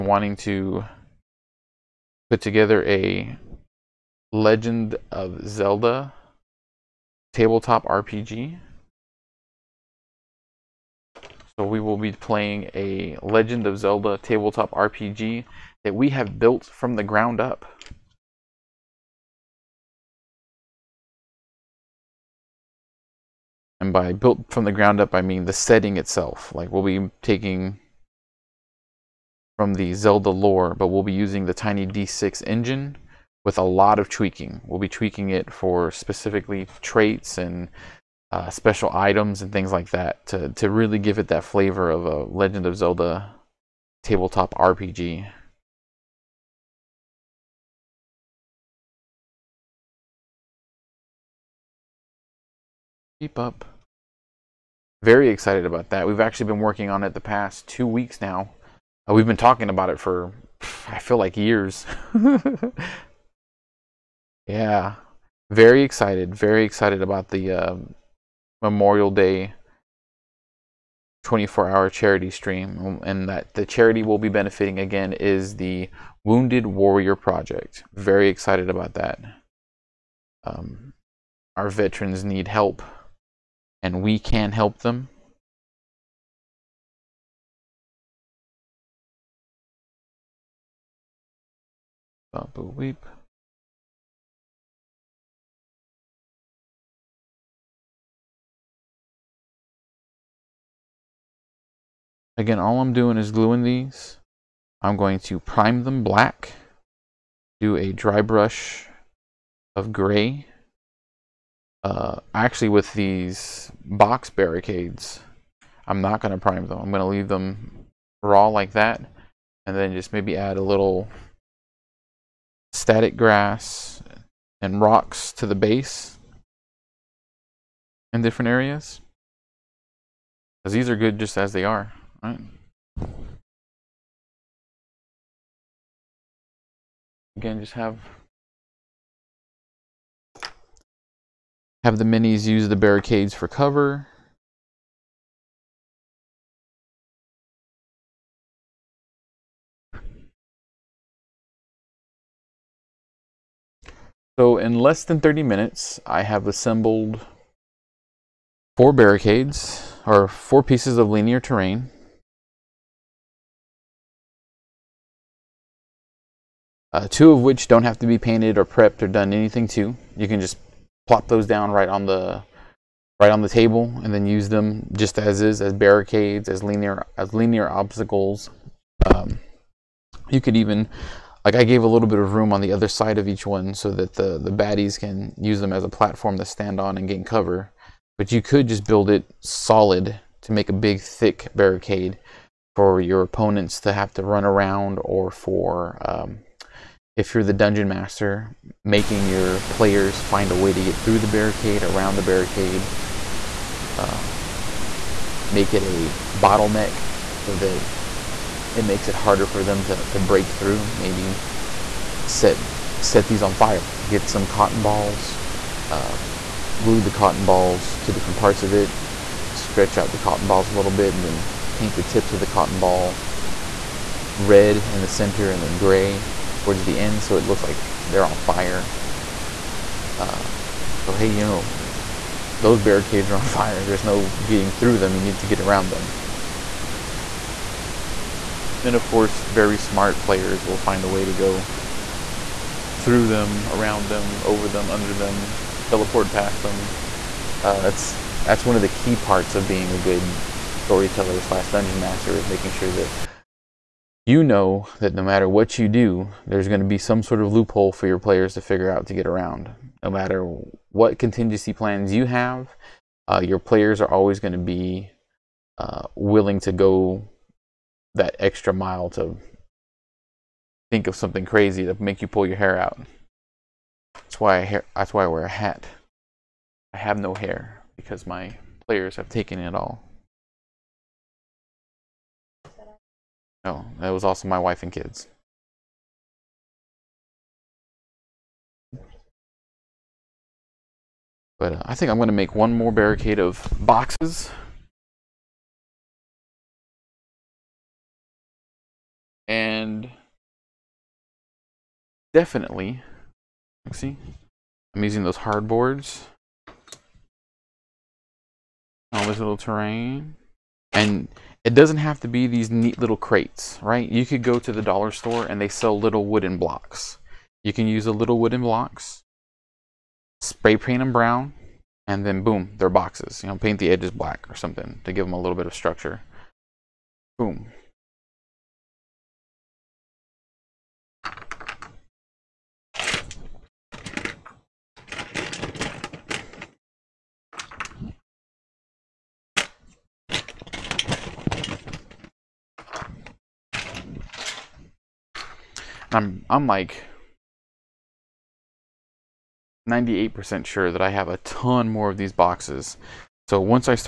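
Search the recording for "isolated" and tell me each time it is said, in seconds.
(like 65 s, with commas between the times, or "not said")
not said.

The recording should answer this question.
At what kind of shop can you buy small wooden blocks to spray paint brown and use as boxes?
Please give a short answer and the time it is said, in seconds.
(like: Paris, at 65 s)
Dollar store, at 314 s.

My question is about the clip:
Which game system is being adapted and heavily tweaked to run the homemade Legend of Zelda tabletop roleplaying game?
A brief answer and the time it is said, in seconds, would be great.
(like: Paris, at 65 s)
Tiny D6, at 31 s.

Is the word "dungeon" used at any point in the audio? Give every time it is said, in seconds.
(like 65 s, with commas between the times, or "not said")
197 s, 251 s.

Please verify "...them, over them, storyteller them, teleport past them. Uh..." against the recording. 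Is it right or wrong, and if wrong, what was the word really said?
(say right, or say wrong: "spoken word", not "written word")
wrong: "under", not "storyteller".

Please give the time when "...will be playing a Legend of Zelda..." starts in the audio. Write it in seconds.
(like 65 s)
11 s.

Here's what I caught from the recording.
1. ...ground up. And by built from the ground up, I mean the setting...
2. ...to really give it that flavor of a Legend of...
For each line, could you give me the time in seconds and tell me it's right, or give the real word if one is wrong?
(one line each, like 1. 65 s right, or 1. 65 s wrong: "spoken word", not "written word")
1. 17 s right
2. 40 s right.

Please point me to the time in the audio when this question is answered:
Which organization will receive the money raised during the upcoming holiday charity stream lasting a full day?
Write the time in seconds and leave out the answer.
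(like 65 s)
76 s.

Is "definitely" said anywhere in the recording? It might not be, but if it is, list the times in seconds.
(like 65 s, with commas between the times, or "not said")
302 s.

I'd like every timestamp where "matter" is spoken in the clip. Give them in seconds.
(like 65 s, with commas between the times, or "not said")
255 s, 260 s.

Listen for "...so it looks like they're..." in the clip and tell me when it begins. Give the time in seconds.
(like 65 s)
227 s.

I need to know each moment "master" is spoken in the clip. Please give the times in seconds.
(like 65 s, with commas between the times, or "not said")
197 s, 251 s.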